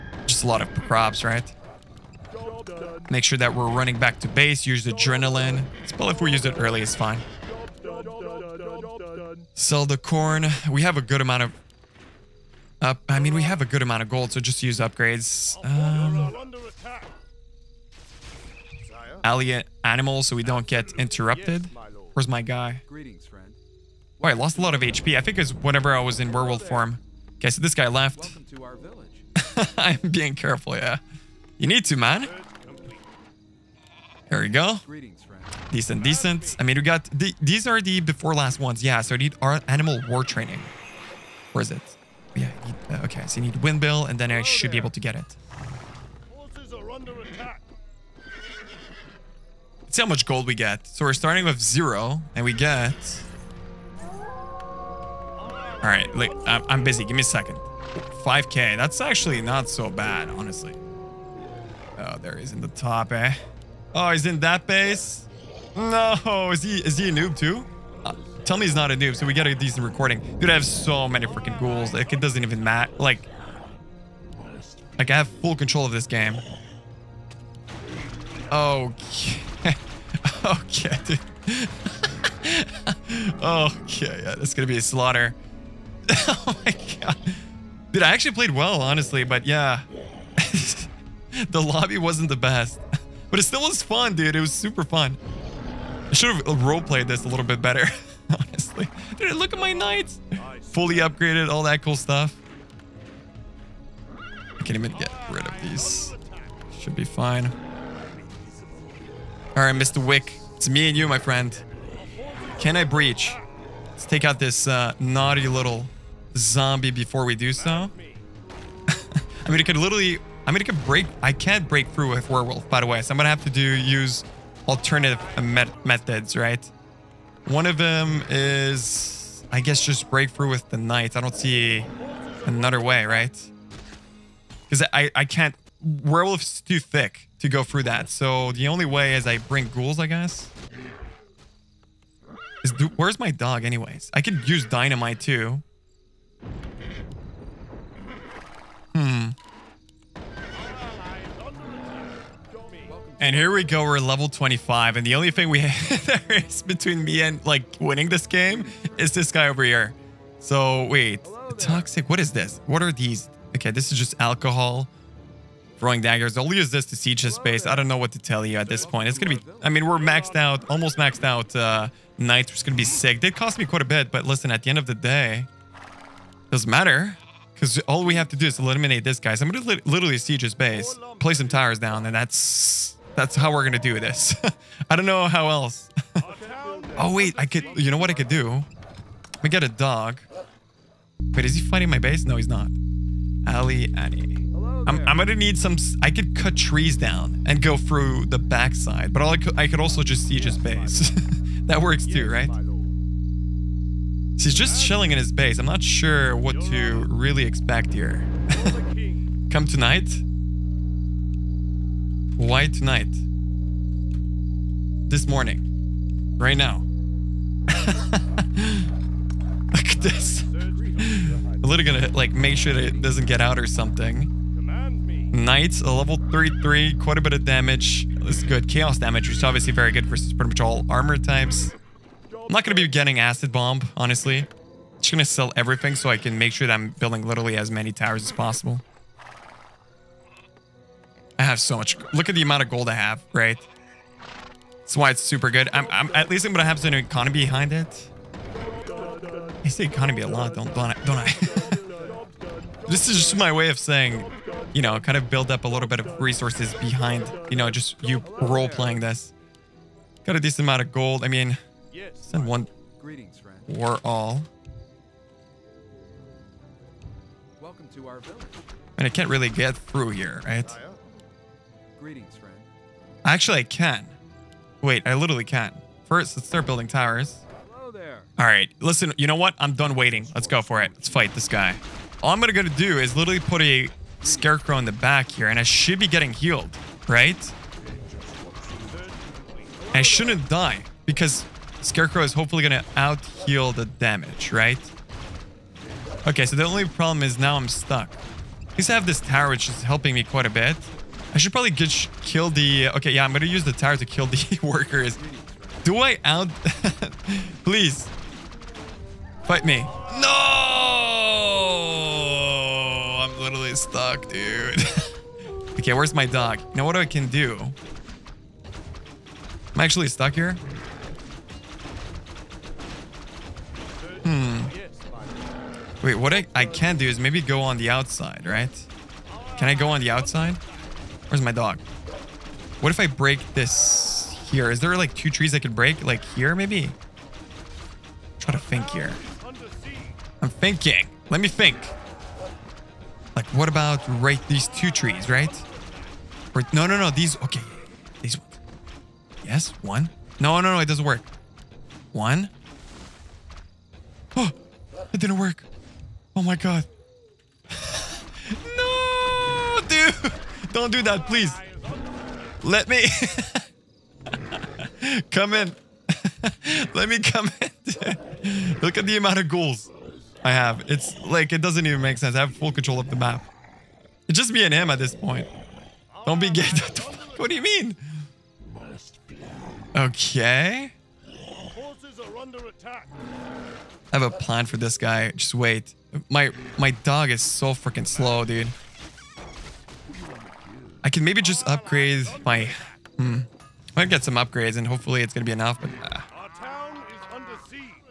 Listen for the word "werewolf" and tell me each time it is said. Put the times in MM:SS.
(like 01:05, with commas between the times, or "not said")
00:26, 02:02, 02:15.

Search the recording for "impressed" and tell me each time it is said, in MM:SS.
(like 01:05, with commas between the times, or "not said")
not said.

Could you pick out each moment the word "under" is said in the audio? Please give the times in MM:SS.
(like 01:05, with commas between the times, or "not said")
06:22.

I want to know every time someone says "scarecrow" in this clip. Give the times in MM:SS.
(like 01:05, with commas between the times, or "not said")
04:44, 04:51.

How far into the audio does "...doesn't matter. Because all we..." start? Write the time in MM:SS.
02:56.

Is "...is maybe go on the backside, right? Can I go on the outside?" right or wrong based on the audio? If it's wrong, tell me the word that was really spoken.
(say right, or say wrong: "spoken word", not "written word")
wrong: "outside", not "backside".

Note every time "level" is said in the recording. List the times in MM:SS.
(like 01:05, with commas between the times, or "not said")
02:33, 03:45.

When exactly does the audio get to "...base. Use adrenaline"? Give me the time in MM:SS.
00:04.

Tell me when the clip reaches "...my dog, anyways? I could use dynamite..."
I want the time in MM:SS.
02:23.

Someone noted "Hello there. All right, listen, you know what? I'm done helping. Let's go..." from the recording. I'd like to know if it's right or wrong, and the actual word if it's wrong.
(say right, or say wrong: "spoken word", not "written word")
wrong: "waiting", not "helping".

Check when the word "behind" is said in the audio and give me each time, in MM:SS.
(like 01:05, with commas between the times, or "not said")
04:07, 04:16.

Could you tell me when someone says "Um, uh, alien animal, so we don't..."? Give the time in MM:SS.
00:15.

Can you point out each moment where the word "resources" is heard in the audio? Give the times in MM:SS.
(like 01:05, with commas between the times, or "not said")
04:16.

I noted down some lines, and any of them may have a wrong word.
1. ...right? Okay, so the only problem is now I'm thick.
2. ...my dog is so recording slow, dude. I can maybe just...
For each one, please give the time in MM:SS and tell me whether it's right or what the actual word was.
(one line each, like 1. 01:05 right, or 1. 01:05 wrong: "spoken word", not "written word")
1. 04:54 wrong: "stuck", not "thick"
2. 06:26 wrong: "freaking", not "recording".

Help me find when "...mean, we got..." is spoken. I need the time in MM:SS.
00:36.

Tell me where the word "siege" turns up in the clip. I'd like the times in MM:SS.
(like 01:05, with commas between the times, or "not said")
02:46, 03:00, 03:20.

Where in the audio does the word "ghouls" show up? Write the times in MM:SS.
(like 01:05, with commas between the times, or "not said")
01:11, 02:19, 06:09.